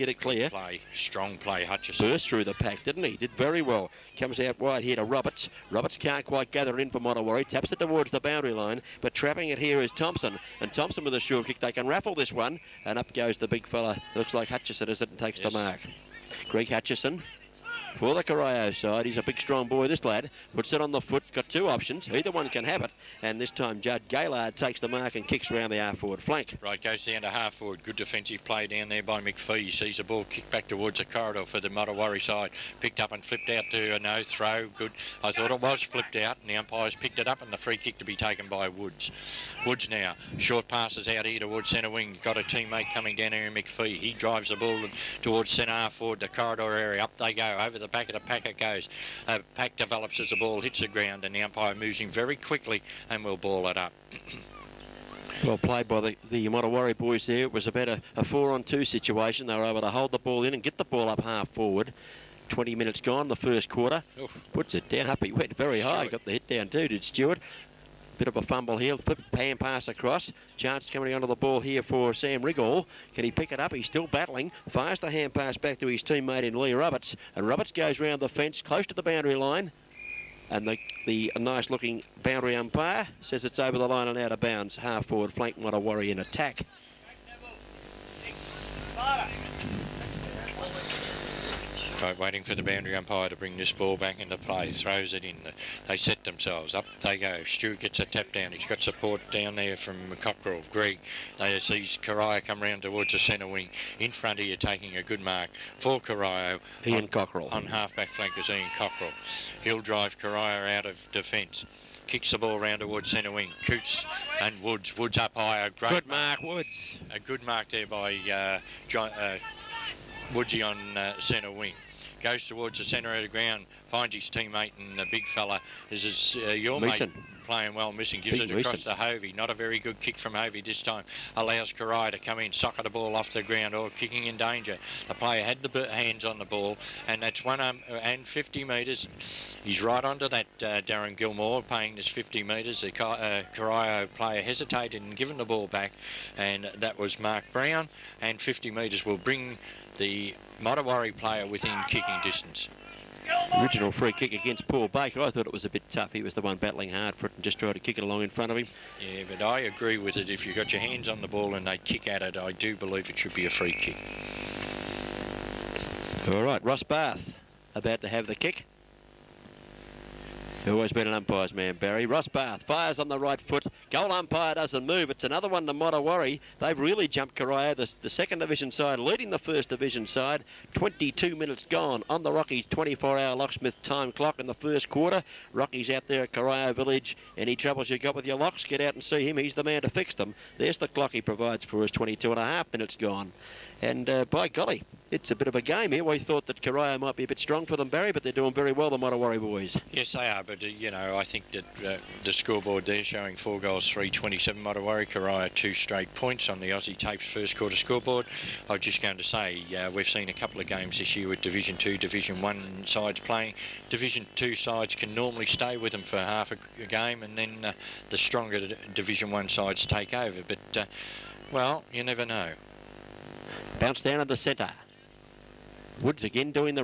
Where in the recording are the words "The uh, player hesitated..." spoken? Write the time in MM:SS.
02:22.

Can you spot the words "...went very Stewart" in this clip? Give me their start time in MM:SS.
01:05.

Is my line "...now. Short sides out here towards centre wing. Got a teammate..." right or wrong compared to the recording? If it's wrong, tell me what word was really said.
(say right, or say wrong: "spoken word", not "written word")
wrong: "passes", not "sides".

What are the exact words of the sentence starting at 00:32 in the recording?
Picked up and flipped out to a no throw.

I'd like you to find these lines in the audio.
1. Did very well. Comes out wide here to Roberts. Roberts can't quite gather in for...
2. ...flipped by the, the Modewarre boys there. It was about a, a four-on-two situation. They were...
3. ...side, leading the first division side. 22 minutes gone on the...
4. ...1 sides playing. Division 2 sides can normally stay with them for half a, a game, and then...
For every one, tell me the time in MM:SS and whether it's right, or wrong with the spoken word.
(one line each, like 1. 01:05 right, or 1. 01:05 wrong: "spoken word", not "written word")
1. 00:03 right
2. 00:55 wrong: "played", not "flipped"
3. 02:58 right
4. 03:32 right.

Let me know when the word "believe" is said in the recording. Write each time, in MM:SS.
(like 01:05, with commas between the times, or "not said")
02:42.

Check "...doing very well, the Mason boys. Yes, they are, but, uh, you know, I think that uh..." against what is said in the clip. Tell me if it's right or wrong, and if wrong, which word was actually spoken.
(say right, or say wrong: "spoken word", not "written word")
wrong: "Modewarre", not "Mason".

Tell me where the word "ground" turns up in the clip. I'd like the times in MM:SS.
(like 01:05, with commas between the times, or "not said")
00:50, 02:03, 02:13.